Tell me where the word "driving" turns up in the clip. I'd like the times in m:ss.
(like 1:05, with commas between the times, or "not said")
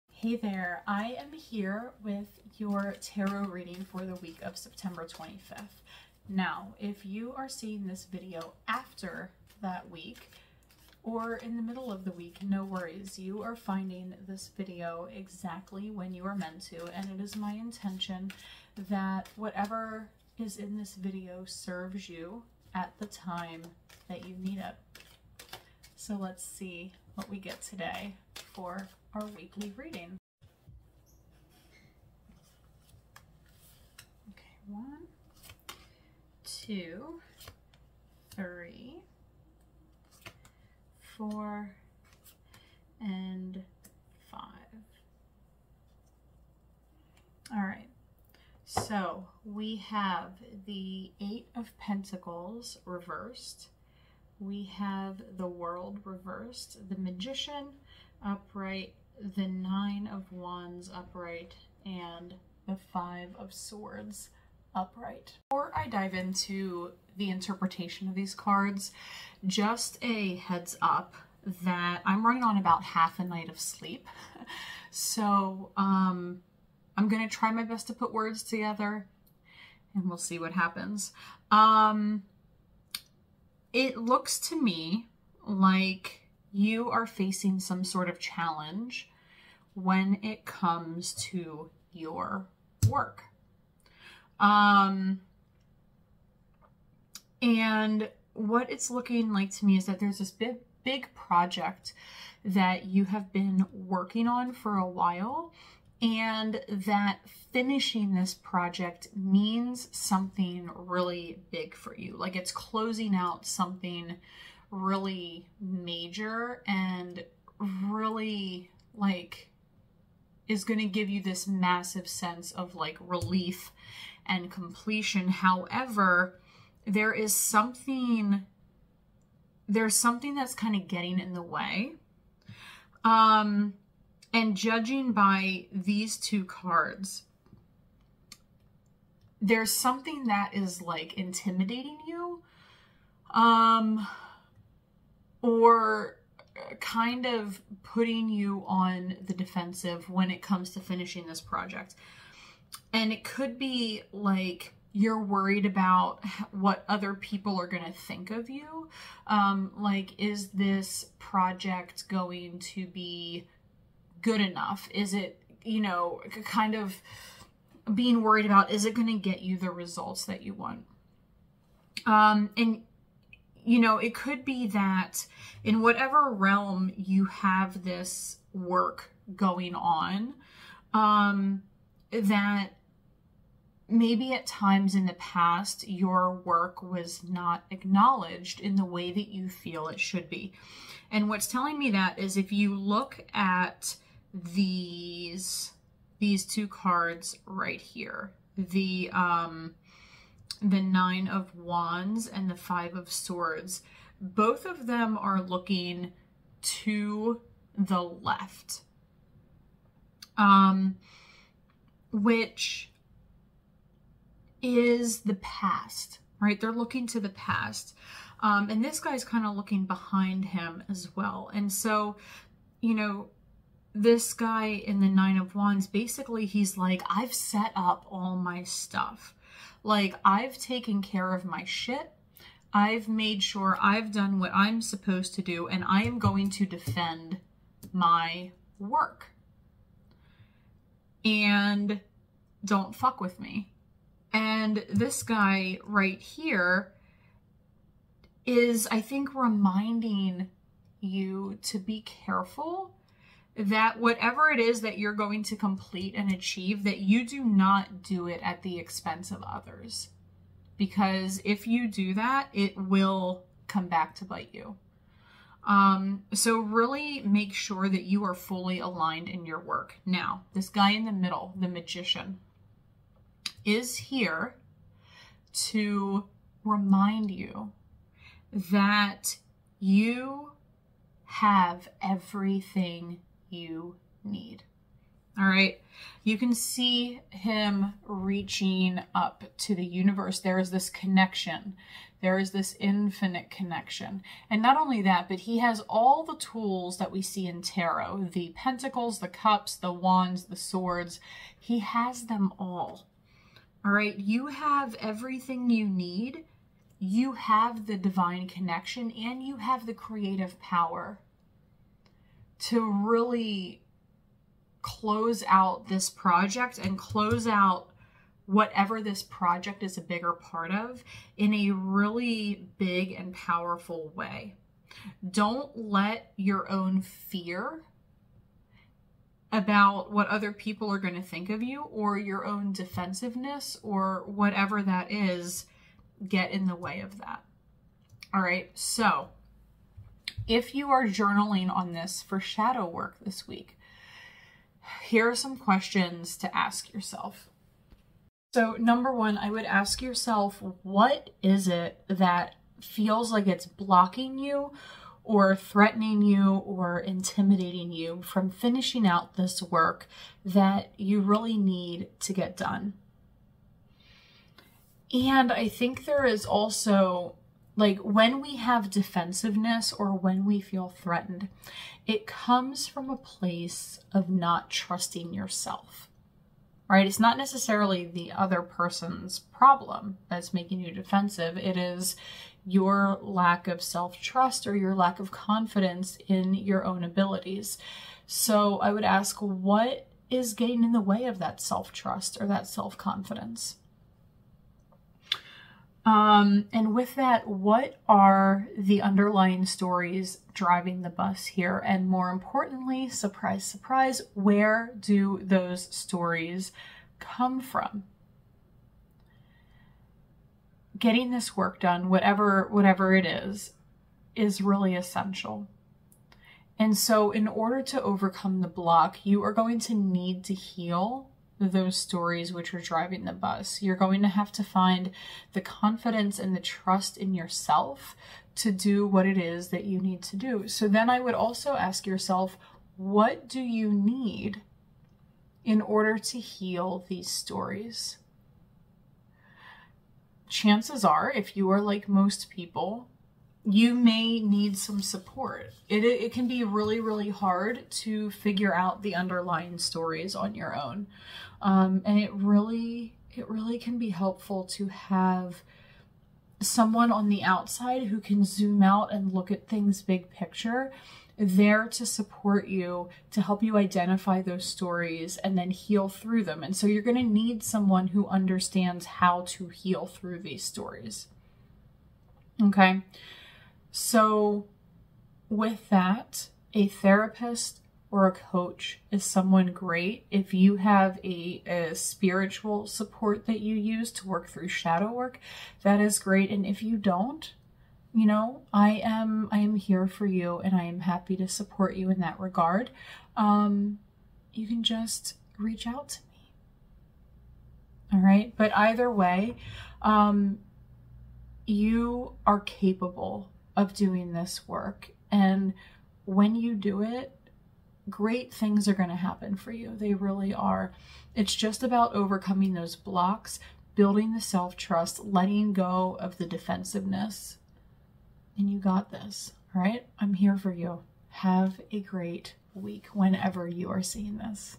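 6:40, 7:02.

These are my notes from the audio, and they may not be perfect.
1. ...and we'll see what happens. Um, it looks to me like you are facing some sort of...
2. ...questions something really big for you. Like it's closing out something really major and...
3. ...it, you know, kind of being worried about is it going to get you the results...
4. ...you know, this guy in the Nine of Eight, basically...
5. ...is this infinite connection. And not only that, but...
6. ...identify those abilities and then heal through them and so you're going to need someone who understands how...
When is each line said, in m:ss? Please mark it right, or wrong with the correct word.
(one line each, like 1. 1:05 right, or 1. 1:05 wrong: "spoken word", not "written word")
1. 1:19 right
2. 1:49 wrong: "means", not "questions"
3. 2:45 right
4. 3:42 wrong: "Wands", not "Eight"
5. 4:52 right
6. 7:43 wrong: "stories", not "abilities".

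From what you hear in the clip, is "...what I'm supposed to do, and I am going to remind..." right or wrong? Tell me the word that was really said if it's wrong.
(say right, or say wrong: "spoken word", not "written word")
wrong: "defend", not "remind".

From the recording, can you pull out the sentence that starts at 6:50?
Getting this work done, whatever whatever it is, is really essential.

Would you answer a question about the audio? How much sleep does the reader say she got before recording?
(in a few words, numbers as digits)
half a night.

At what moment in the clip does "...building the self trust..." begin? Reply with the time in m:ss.
8:33.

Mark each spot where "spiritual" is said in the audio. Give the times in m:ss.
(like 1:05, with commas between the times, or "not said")
8:01.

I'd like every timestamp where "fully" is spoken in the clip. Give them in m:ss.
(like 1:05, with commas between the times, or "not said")
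4:28.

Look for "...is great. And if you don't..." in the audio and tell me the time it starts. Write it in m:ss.
8:05.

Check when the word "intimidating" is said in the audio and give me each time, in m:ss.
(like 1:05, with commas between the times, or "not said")
2:21, 5:56.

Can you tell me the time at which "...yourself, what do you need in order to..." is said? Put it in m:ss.
7:12.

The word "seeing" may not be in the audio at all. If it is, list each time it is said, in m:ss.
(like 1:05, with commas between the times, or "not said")
0:07, 8:44.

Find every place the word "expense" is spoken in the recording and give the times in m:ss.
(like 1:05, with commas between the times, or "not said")
4:18.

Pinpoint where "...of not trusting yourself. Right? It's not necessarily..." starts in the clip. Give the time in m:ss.
6:14.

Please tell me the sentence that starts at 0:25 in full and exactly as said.
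So let's see what we get today for our weekly reading.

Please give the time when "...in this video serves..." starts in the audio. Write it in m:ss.
0:20.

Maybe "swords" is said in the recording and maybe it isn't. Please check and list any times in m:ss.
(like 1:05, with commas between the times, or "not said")
1:03, 3:23, 5:00.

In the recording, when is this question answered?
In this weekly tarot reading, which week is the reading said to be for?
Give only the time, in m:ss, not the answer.
0:04.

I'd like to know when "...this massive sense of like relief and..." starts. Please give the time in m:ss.
2:01.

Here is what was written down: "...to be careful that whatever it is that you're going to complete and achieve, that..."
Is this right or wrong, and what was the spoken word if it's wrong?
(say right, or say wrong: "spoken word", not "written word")
right.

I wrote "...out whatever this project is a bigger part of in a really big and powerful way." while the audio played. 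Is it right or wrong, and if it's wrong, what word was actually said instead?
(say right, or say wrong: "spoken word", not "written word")
right.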